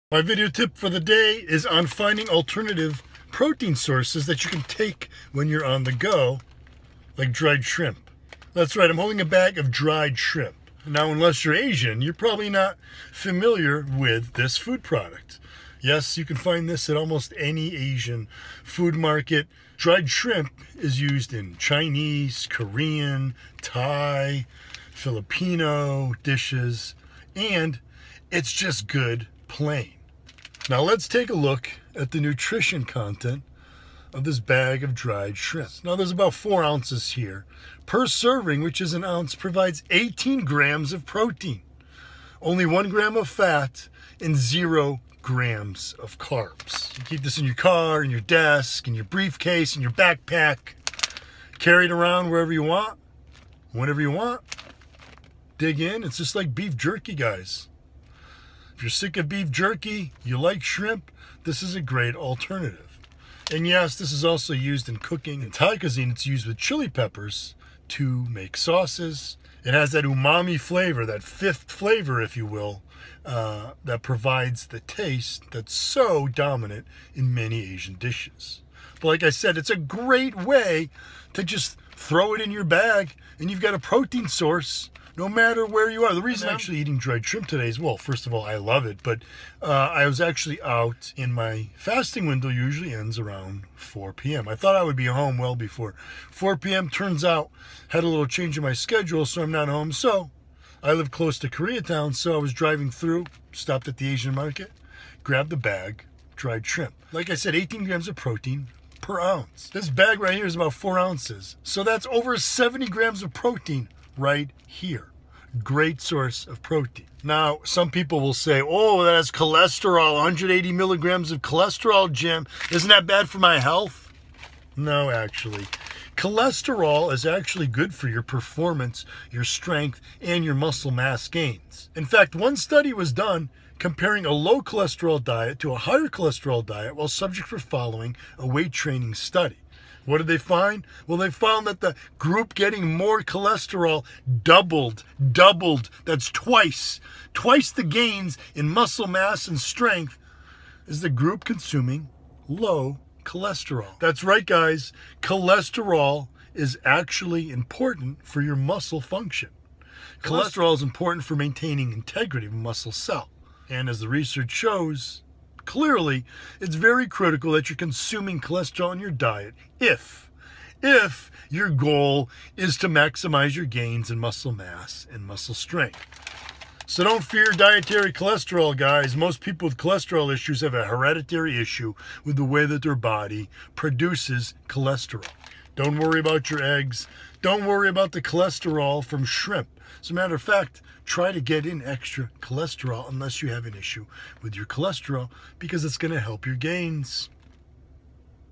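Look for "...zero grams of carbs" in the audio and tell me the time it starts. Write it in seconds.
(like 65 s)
44 s.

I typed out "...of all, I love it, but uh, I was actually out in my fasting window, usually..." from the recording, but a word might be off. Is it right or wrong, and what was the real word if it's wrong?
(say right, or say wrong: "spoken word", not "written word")
right.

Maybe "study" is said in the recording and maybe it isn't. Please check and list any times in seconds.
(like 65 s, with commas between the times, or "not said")
132 s, 139 s.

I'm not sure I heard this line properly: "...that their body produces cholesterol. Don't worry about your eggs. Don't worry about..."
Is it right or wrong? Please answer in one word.
right.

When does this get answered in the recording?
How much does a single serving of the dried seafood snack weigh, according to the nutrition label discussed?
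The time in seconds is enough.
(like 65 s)
38 s.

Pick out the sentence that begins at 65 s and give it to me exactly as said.
In Thai cuisine, it's used with chili peppers to make sauces.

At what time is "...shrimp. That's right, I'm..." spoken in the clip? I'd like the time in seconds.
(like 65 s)
7 s.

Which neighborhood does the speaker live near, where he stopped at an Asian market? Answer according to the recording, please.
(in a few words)
Koreatown.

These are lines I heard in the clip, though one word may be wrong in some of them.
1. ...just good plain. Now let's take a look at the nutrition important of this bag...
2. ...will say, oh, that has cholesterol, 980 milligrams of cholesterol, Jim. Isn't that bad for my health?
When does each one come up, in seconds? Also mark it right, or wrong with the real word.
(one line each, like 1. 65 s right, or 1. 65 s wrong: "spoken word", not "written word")
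1. 28 s wrong: "content", not "important"
2. 118 s wrong: "180", not "980".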